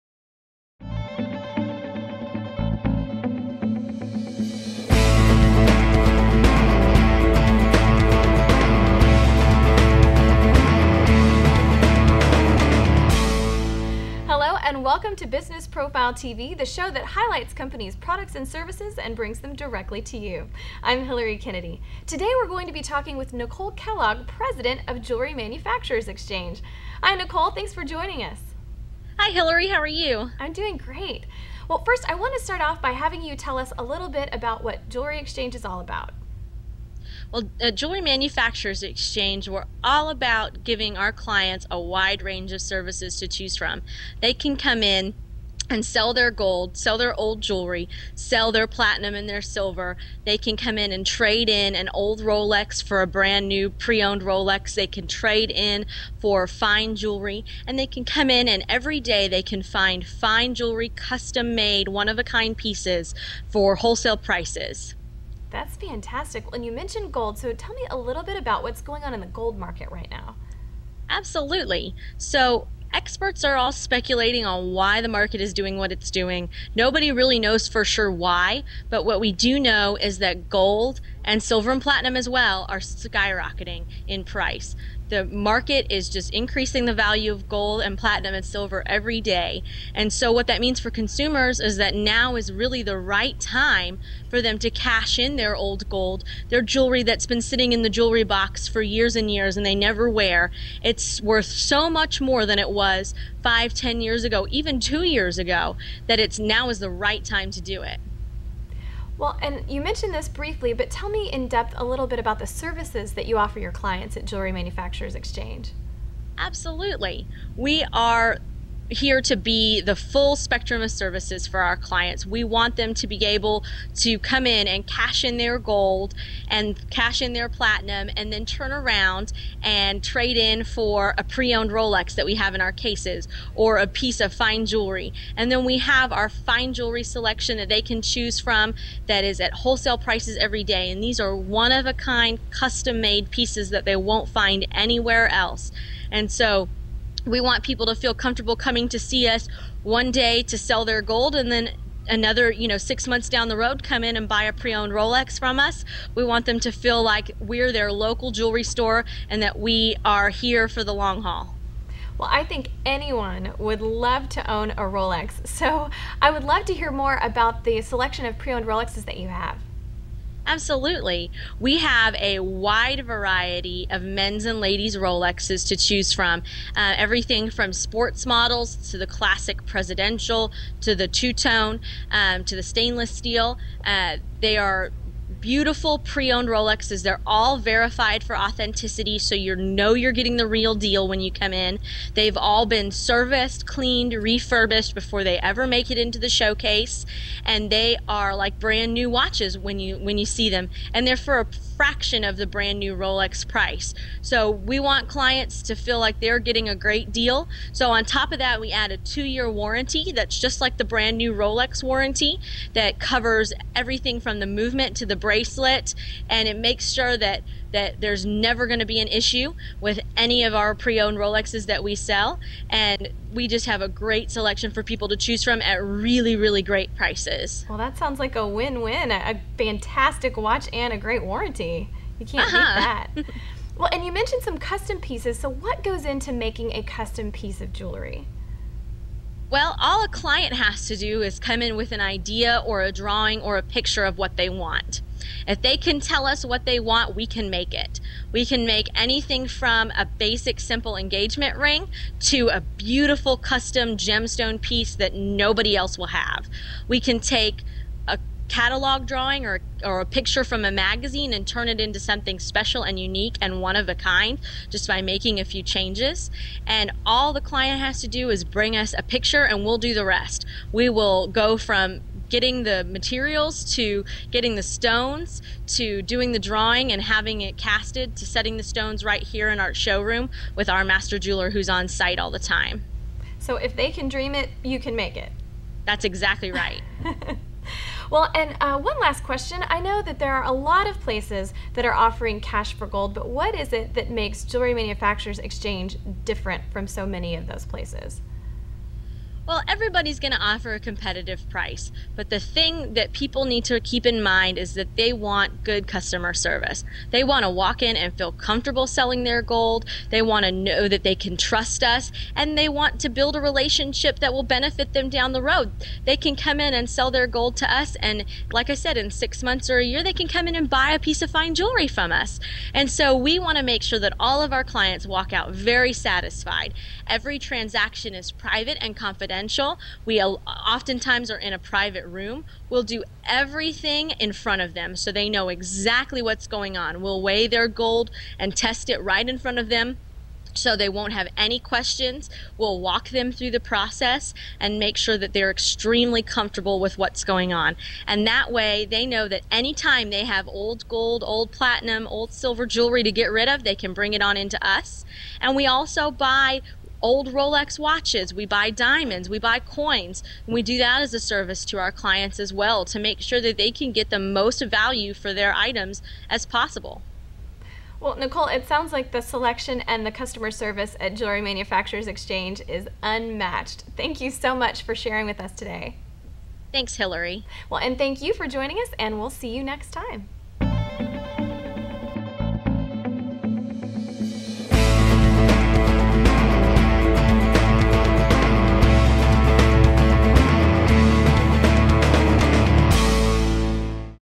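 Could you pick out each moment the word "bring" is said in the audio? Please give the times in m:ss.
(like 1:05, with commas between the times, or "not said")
0:19, 4:28, 5:53.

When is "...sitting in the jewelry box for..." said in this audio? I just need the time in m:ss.
1:37.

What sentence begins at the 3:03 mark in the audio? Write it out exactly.
Uh, they are beautiful pre-owned Rolexes.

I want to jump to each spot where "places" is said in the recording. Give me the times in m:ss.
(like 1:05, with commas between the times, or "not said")
4:50, 4:57.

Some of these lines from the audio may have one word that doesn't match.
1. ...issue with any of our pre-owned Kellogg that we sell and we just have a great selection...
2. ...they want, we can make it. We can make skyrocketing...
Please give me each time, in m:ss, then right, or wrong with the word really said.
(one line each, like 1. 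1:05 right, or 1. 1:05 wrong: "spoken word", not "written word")
1. 3:39 wrong: "Rolexes", not "Kellogg"
2. 4:06 wrong: "anything", not "skyrocketing".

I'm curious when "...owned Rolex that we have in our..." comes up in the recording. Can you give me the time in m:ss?
2:11.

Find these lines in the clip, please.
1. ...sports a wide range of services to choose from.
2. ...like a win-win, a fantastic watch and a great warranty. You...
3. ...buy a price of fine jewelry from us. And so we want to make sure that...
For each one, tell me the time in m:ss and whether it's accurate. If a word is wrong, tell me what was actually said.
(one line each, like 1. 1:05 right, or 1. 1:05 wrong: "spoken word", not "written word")
1. 0:41 wrong: "clients", not "sports"
2. 3:48 right
3. 5:20 wrong: "piece", not "price".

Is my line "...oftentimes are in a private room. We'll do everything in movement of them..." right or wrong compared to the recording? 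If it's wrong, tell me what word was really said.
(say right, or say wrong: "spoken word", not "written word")
wrong: "front", not "movement".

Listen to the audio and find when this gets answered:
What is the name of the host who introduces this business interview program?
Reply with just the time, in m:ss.
0:21.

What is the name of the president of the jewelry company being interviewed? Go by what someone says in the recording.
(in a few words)
Nicole Kellogg.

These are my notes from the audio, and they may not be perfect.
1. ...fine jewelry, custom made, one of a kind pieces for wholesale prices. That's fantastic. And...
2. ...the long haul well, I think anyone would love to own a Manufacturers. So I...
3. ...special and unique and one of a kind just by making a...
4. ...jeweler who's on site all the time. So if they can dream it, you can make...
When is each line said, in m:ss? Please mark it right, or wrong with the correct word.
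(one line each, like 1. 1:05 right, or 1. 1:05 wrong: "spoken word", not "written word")
1. 1:00 right
2. 2:40 wrong: "Rolex", not "Manufacturers"
3. 4:22 right
4. 4:41 right.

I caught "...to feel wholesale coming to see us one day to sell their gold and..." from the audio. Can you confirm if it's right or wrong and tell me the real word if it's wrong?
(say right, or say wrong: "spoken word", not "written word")
wrong: "comfortable", not "wholesale".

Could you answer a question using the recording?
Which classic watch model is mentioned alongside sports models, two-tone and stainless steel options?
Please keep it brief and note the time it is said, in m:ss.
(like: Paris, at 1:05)
Presidential, at 2:59.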